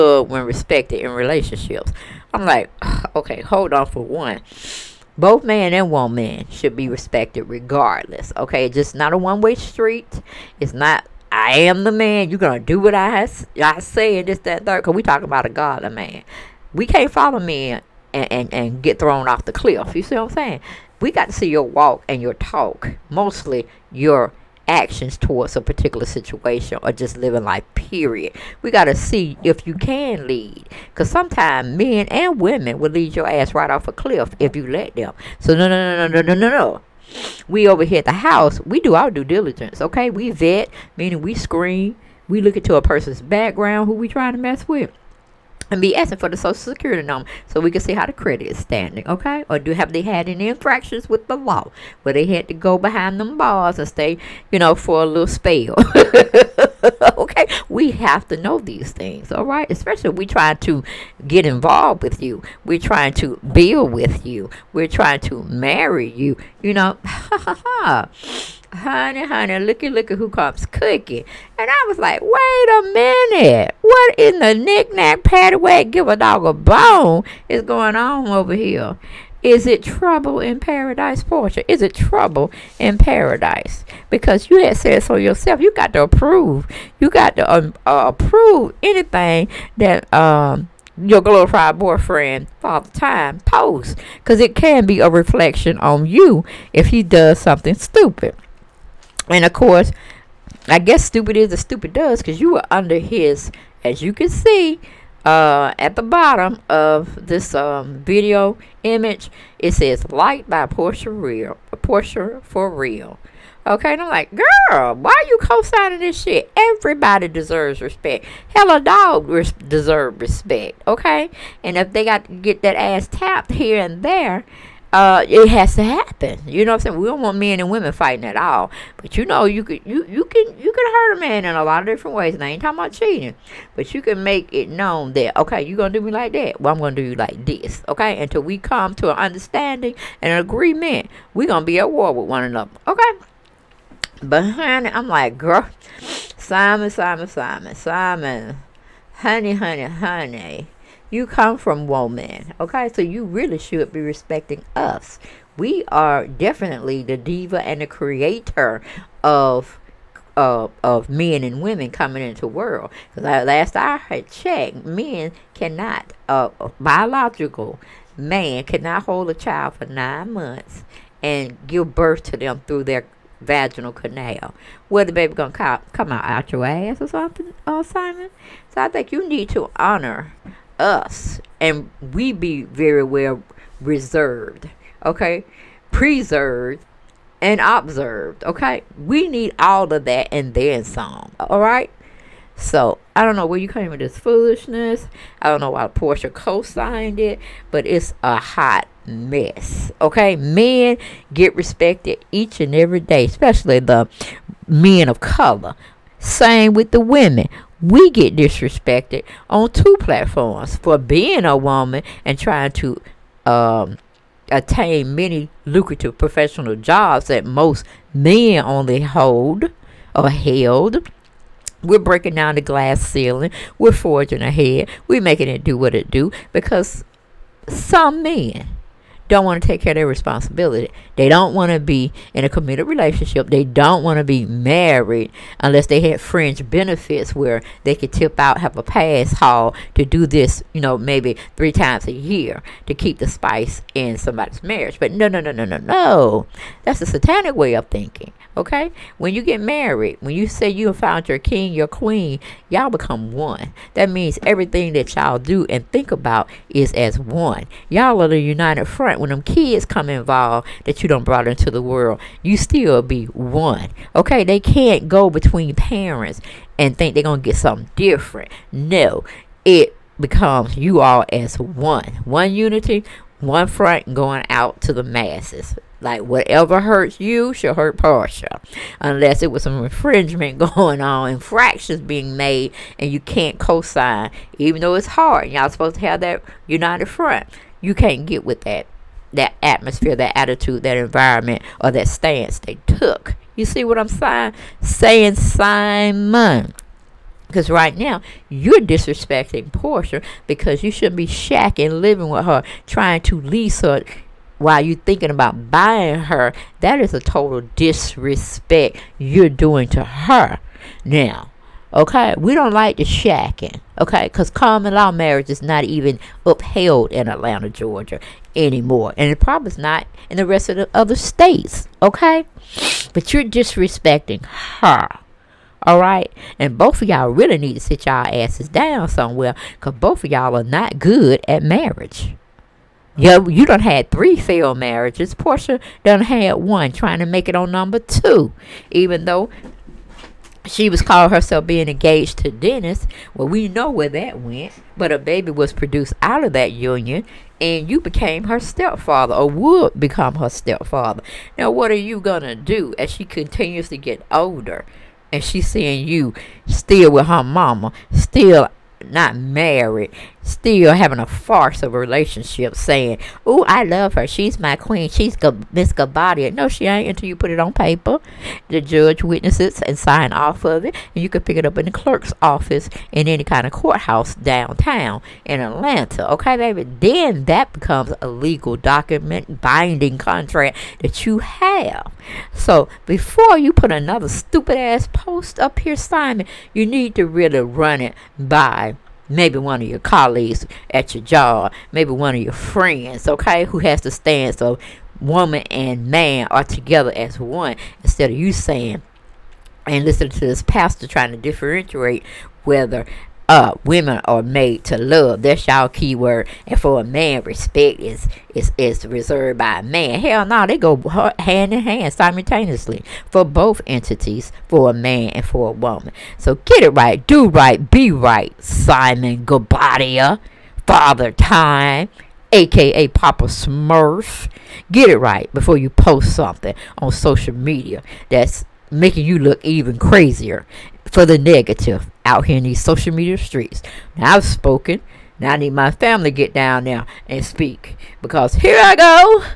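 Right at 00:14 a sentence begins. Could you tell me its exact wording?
Cause we talking about a godly man.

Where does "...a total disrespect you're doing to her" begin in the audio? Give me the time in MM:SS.
05:07.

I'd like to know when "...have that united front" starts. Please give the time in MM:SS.
04:46.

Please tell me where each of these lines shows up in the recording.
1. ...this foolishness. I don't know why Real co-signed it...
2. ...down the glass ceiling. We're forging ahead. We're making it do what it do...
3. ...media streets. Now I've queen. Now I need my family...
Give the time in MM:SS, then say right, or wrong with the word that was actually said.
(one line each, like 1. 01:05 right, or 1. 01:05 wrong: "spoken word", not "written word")
1. 03:13 wrong: "Porsha", not "Real"
2. 03:42 right
3. 07:13 wrong: "spoken", not "queen".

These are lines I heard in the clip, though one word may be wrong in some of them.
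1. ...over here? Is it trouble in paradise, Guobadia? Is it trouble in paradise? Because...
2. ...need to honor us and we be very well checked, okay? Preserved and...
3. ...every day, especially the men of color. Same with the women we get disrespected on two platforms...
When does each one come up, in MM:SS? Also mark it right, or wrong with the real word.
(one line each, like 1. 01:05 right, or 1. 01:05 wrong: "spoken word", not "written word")
1. 01:18 wrong: "Porsha", not "Guobadia"
2. 02:59 wrong: "reserved", not "checked"
3. 03:22 right.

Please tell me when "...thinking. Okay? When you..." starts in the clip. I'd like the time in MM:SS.
04:07.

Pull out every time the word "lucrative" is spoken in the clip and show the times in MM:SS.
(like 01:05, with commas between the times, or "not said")
03:35.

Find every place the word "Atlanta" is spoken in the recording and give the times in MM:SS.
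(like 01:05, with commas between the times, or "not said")
05:17, 06:15.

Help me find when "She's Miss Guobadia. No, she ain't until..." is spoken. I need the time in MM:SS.
06:05.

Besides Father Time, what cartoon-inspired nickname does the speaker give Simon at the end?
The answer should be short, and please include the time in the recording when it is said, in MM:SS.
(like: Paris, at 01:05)
Papa Smurf, at 07:03.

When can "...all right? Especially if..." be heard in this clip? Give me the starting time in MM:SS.
00:59.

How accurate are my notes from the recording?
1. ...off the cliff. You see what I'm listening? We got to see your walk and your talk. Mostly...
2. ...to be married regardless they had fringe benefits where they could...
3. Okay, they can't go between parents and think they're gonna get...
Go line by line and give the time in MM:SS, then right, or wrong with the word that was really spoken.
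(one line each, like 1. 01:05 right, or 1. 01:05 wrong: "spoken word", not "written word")
1. 00:19 wrong: "saying", not "listening"
2. 03:54 wrong: "unless", not "regardless"
3. 04:24 right.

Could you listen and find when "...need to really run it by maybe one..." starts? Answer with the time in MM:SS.
06:26.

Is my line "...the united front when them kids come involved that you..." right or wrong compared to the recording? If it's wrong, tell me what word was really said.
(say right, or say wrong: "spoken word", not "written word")
right.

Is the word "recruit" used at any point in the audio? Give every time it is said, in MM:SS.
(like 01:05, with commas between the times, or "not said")
not said.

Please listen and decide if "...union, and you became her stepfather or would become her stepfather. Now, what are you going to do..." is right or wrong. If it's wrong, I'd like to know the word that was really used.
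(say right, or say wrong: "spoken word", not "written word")
right.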